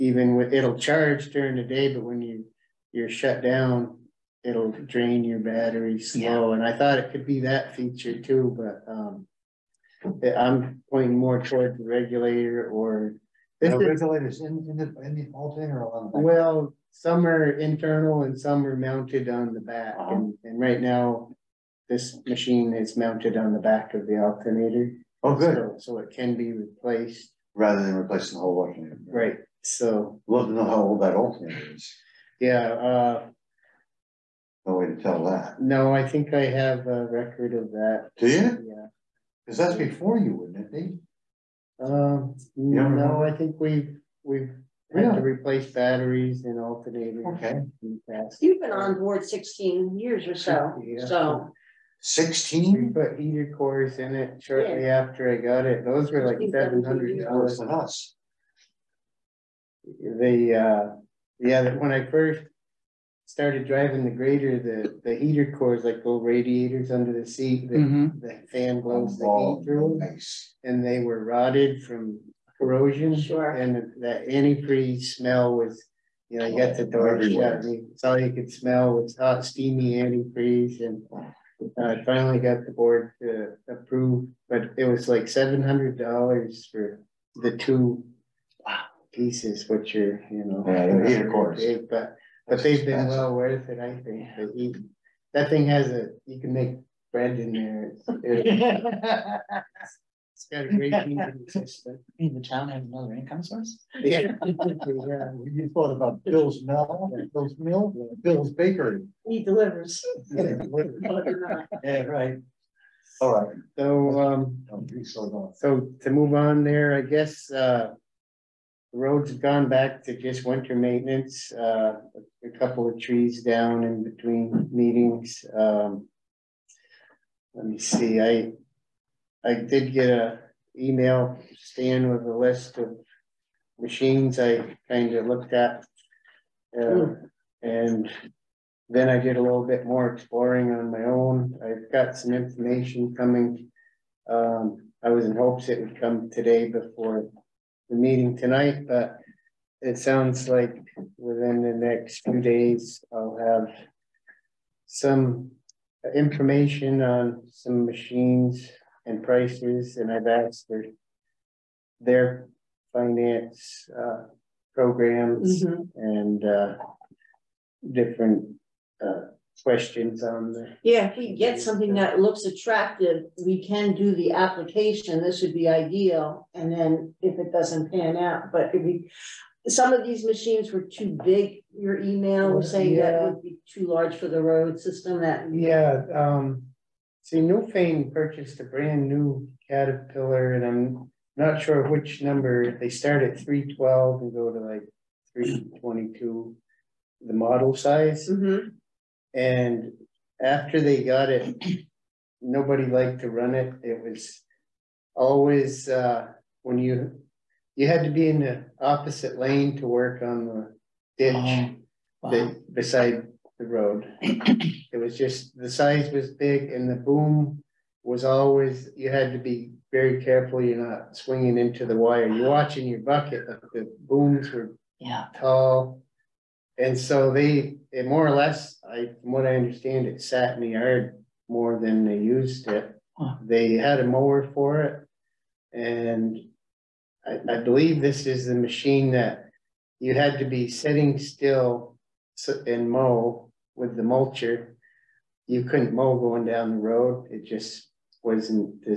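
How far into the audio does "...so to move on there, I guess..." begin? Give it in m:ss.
1:55.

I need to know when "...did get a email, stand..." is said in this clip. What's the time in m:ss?
2:09.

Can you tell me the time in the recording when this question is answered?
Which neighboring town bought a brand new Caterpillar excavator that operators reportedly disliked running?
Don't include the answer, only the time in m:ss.
3:07.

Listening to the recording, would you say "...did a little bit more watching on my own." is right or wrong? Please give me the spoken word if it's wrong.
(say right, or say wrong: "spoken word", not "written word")
wrong: "exploring", not "watching".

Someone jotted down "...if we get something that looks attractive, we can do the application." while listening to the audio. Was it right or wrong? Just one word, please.
right.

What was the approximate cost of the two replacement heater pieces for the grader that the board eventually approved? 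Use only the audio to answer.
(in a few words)
$700.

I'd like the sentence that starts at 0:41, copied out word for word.
Um, You no, I think we've, we've had Really?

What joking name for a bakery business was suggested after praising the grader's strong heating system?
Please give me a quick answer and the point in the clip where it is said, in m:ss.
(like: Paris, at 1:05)
Bill's Bakery, at 1:48.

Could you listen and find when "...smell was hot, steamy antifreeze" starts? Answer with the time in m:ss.
1:18.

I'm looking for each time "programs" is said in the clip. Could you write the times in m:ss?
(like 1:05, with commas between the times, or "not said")
2:44.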